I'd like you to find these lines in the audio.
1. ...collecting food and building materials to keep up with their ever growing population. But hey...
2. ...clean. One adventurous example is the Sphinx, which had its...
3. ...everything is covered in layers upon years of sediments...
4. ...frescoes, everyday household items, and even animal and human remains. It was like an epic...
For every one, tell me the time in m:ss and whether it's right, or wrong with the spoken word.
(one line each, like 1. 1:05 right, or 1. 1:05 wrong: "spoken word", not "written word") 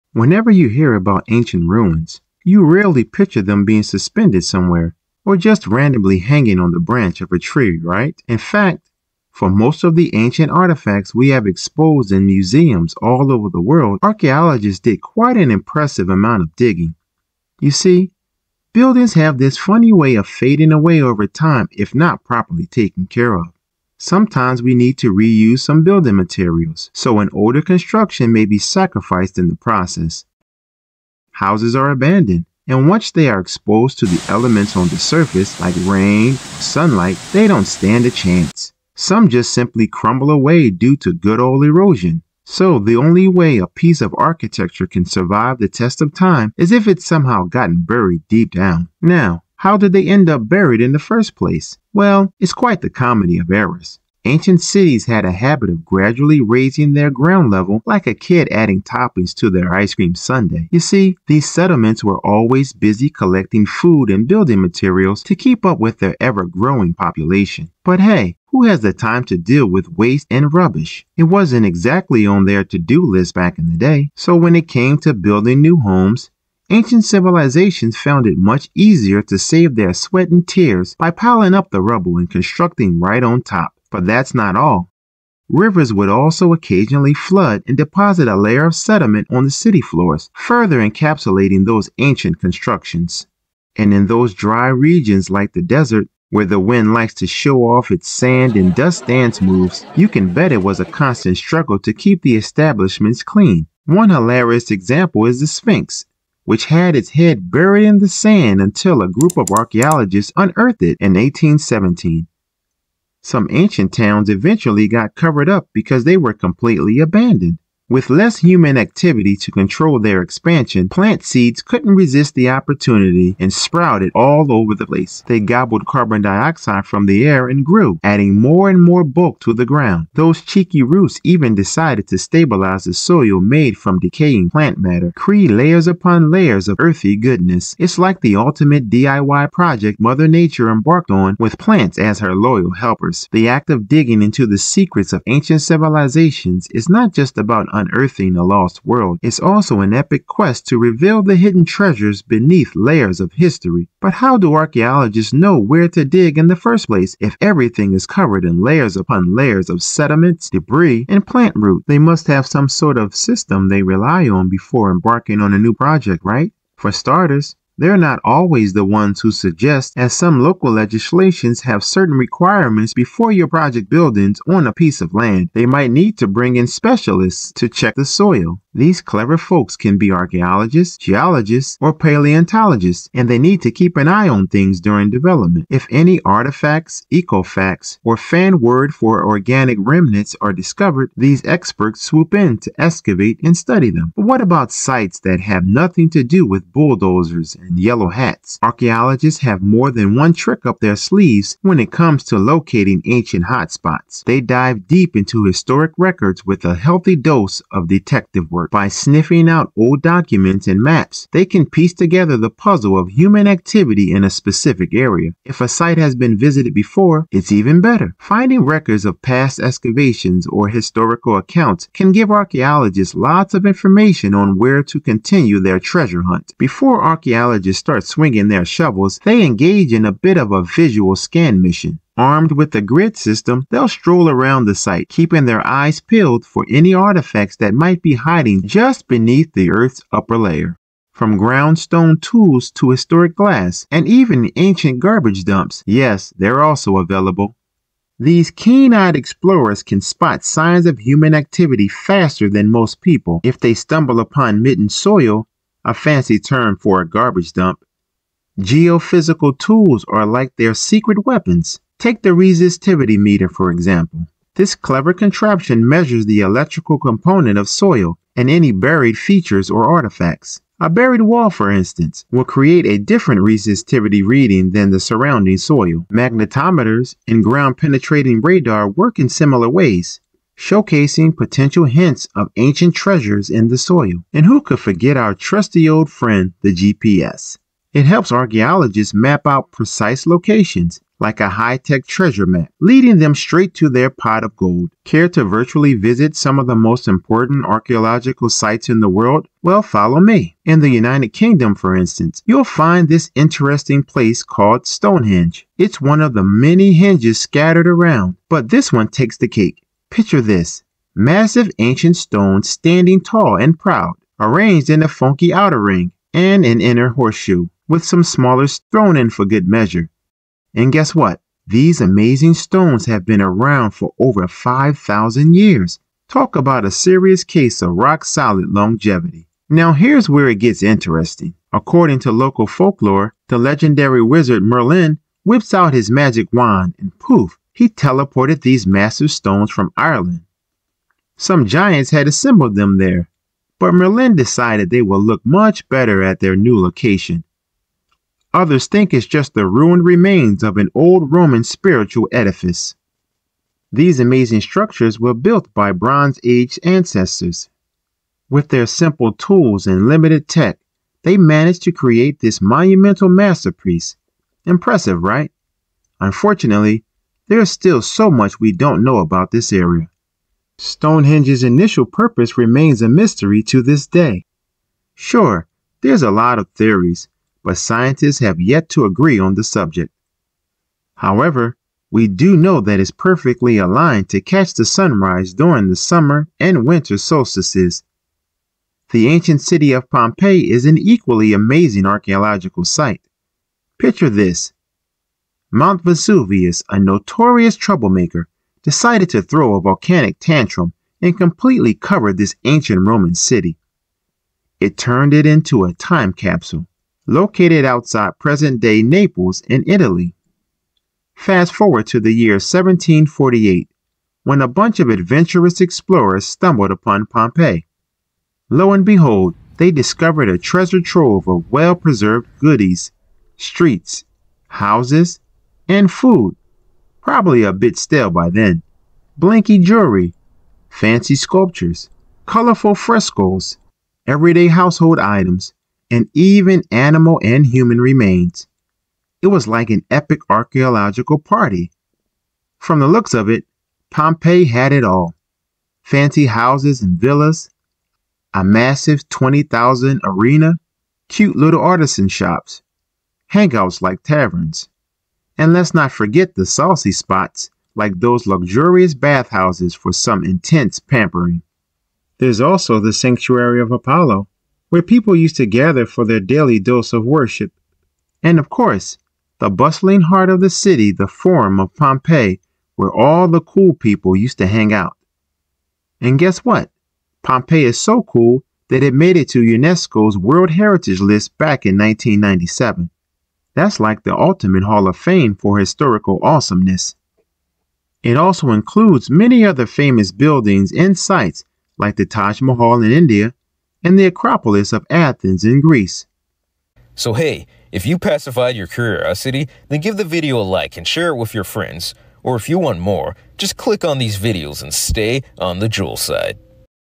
1. 1:03 right
2. 1:43 wrong: "hilarious", not "adventurous"
3. 2:37 wrong: "layers", not "years"
4. 7:12 right.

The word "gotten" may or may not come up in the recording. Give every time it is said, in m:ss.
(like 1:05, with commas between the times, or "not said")
0:47.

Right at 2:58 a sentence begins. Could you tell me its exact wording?
These clever folks can be archaeologists, geologists, or paleontologists, and they need to keep an eye on things during development.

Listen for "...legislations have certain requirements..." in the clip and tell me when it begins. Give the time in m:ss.
2:50.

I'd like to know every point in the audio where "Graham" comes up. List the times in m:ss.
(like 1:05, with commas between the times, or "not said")
not said.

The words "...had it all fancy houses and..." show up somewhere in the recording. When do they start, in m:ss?
7:24.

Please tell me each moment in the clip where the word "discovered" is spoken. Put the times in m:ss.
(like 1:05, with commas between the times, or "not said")
3:10, 6:59.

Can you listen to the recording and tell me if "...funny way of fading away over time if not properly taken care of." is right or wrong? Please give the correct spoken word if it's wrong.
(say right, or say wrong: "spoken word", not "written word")
right.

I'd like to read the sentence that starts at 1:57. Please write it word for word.
With less human activity to control their expansion, plant seeds couldn't resist the opportunity and sprouted all over the place.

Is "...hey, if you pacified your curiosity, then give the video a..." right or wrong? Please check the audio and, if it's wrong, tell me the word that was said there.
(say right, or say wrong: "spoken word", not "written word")
right.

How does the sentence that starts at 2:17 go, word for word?
It's like the ultimate DIY project Mother Nature embarked on with plants as her loyal helpers.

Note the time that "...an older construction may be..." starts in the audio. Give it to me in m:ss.
0:27.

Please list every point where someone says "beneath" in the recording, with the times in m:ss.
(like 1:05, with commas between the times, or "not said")
2:32, 3:59.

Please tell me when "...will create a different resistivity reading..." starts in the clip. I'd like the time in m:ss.
4:32.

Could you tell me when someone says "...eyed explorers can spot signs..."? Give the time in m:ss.
4:08.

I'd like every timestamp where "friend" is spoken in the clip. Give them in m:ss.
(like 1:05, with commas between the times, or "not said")
4:46, 8:21.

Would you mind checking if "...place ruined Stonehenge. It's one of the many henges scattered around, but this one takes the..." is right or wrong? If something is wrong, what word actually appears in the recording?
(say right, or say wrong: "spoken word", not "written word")
wrong: "called", not "ruined".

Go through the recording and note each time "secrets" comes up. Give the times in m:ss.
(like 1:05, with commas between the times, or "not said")
2:24, 4:20.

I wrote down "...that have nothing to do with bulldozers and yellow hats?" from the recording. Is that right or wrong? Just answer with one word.
right.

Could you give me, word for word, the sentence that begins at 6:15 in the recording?
Sure, there's a lot of theories, but scientists have yet to agree on the subject.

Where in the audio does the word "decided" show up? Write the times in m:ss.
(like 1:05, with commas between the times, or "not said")
2:11, 5:44, 6:38.